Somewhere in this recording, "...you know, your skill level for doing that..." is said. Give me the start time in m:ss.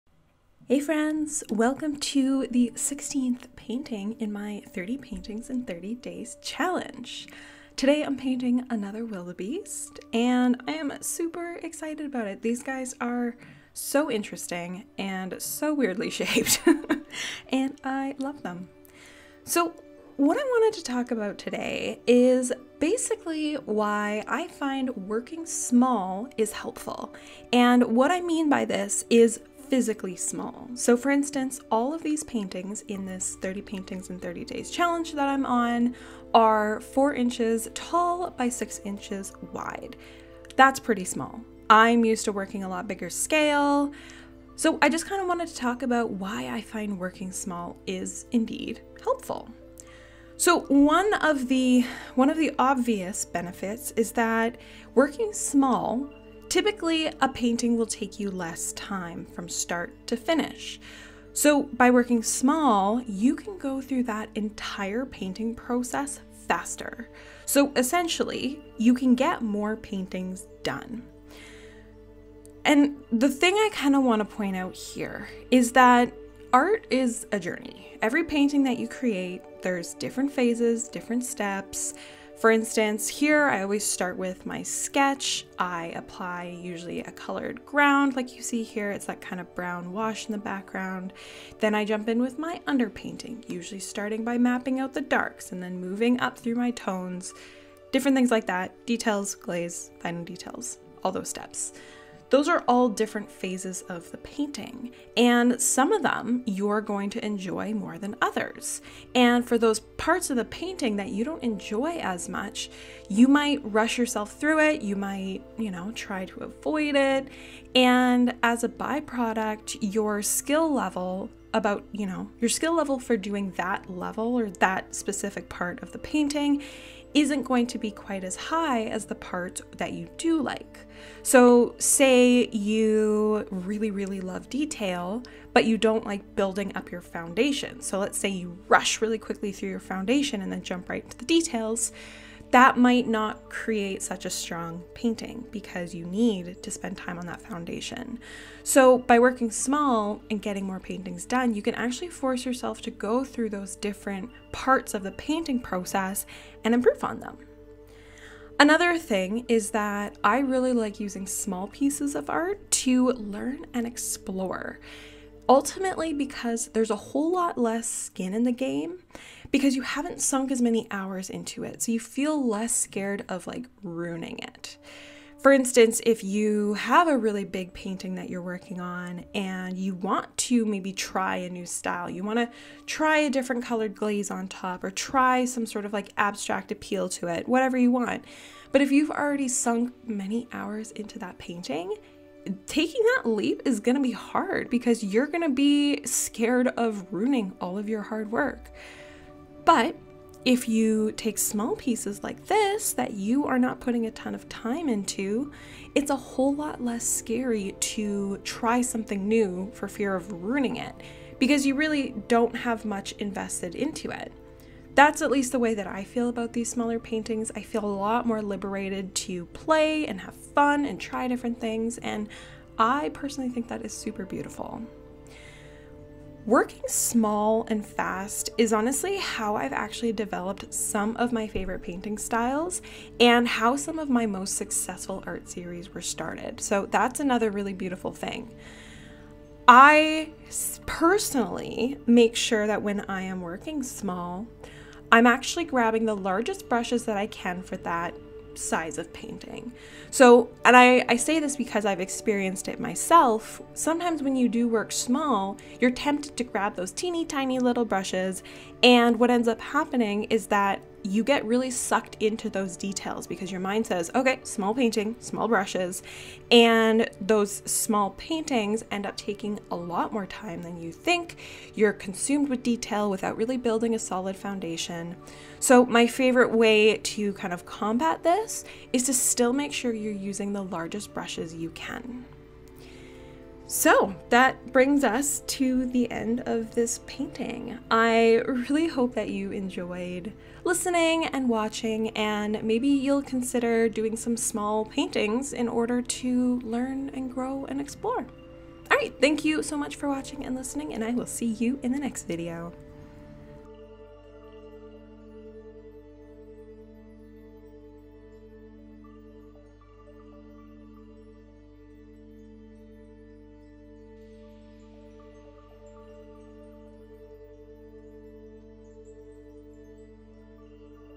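2:01.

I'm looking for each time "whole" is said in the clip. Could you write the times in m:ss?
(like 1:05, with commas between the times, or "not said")
2:46, 3:26.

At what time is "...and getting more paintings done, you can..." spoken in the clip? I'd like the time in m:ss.
2:30.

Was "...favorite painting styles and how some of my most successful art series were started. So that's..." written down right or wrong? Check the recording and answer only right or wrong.
right.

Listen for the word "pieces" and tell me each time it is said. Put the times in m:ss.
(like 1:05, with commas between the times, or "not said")
2:41, 3:21.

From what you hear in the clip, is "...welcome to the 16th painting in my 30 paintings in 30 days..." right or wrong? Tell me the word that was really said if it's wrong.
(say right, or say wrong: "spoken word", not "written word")
right.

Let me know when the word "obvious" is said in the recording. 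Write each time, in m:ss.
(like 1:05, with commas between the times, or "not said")
0:52.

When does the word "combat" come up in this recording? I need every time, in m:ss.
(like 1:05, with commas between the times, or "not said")
4:37.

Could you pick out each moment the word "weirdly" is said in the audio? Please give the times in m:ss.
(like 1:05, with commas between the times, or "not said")
0:15.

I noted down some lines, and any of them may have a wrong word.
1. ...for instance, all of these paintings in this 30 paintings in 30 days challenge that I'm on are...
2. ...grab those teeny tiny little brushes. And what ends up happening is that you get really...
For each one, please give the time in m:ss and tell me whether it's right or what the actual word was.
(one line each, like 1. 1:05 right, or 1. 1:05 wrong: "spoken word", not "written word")
1. 0:30 right
2. 4:16 right.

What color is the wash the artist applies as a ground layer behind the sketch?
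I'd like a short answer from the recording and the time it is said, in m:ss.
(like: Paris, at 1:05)
Brown, at 1:29.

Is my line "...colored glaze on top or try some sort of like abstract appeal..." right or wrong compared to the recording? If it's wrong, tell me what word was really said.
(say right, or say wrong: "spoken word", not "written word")
right.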